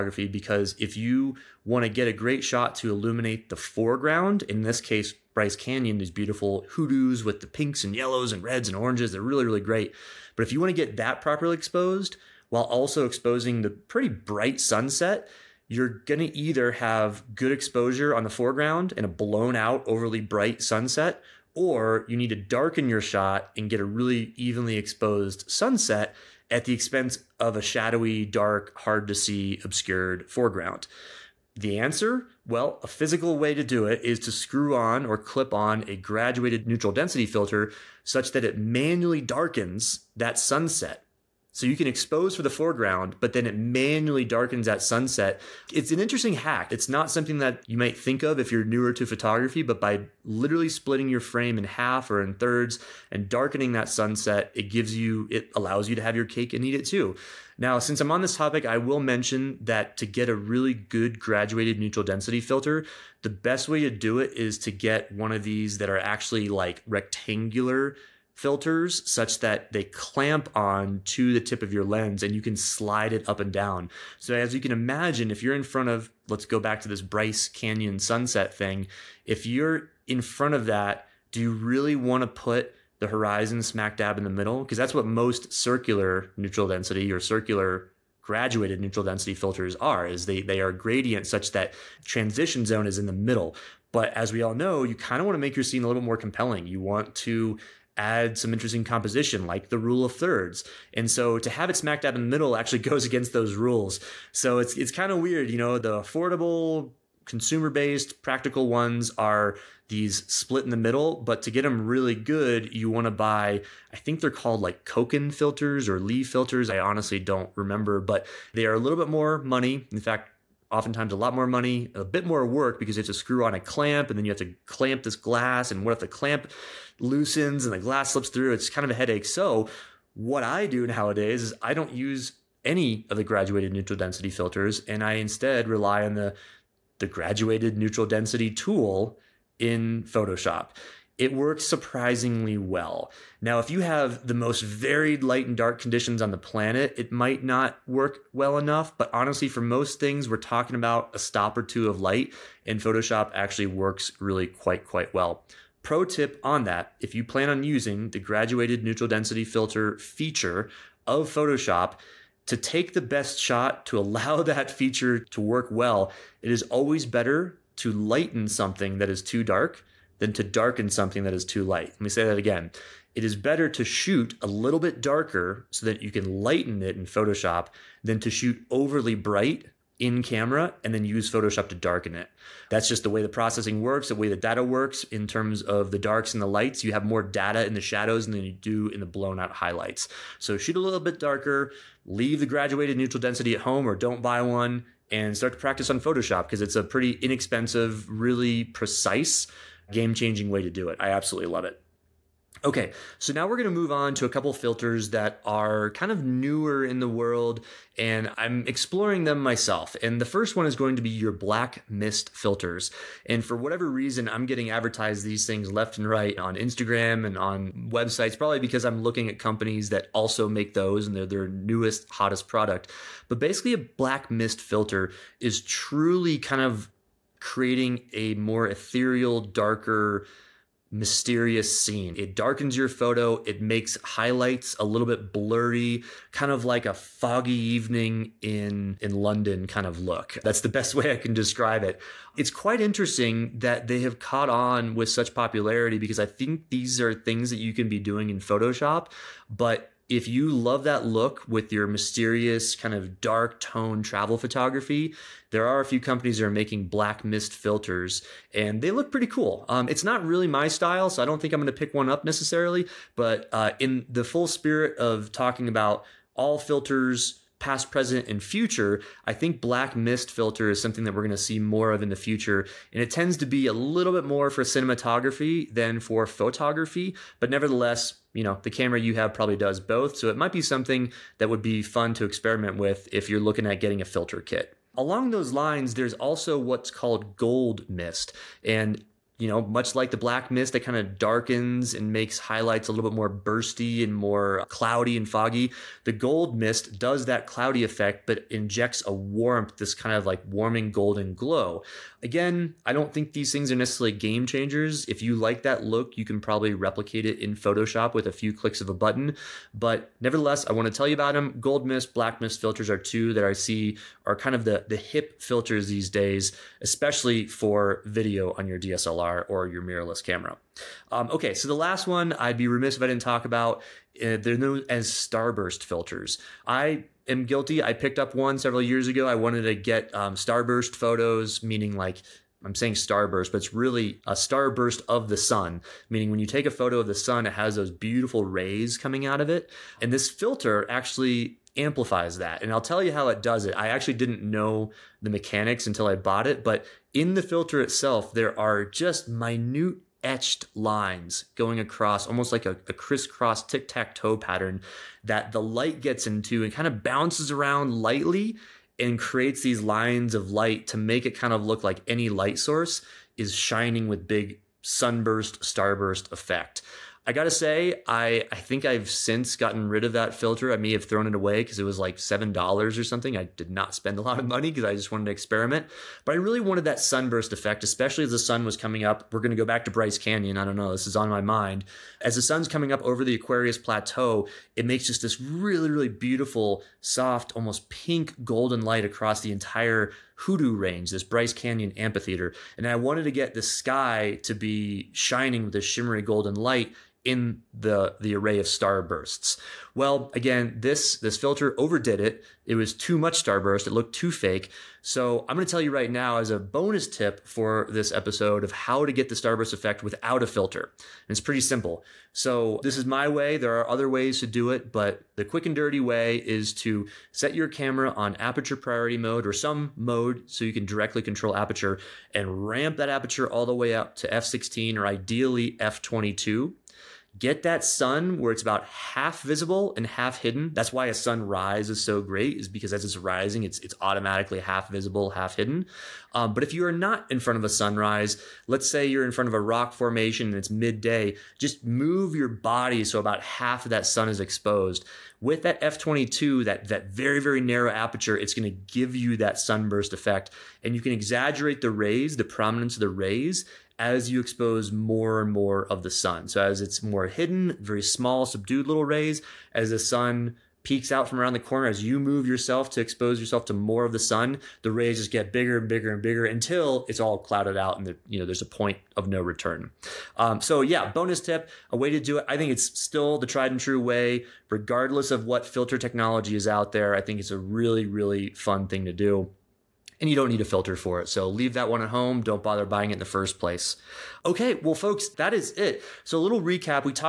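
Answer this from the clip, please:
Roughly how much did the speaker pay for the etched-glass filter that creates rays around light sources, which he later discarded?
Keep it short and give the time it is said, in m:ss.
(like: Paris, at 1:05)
$7, at 6:12.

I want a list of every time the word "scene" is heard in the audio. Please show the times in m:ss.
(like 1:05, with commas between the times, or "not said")
1:35, 3:51.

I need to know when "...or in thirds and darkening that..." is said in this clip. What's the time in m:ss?
0:52.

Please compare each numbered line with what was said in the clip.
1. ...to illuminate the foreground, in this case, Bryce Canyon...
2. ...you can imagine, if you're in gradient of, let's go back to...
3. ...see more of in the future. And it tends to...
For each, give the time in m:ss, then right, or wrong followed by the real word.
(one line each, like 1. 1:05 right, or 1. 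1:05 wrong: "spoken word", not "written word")
1. 0:02 right
2. 1:14 wrong: "front", not "gradient"
3. 4:31 right.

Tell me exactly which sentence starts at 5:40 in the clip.
And this filter actually amplifies that.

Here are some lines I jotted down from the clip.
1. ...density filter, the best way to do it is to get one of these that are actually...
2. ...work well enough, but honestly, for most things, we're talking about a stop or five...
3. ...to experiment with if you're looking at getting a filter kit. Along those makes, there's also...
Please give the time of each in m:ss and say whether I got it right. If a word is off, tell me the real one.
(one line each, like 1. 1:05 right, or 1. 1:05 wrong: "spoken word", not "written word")
1. 1:02 right
2. 2:27 wrong: "two", not "five"
3. 4:42 wrong: "lines", not "makes".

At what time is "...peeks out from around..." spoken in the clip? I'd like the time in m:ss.
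7:40.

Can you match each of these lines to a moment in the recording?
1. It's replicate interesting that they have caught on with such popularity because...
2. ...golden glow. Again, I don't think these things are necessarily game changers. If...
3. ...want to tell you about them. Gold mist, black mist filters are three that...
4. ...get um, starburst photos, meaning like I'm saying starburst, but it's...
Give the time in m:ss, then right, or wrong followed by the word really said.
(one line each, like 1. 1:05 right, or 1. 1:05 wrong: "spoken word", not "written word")
1. 4:02 wrong: "quite", not "replicate"
2. 5:00 right
3. 5:10 wrong: "two", not "three"
4. 5:29 right.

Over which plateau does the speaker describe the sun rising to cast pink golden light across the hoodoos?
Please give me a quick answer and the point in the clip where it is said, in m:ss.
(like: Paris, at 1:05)
Aquarius Plateau, at 6:23.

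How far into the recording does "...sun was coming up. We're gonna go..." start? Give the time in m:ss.
6:18.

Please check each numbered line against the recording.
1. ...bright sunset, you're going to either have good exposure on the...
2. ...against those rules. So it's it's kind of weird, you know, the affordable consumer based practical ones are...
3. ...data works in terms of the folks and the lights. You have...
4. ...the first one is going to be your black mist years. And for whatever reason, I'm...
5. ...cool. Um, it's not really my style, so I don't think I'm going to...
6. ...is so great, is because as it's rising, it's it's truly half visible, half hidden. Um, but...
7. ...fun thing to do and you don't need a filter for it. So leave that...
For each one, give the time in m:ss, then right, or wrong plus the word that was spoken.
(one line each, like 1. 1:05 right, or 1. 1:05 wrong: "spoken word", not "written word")
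1. 0:14 right
2. 1:43 right
3. 3:04 wrong: "darks", not "folks"
4. 3:30 wrong: "filters", not "years"
5. 4:19 right
6. 7:11 wrong: "automatically", not "truly"
7. 7:58 right.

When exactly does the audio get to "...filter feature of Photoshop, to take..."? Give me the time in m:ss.
2:39.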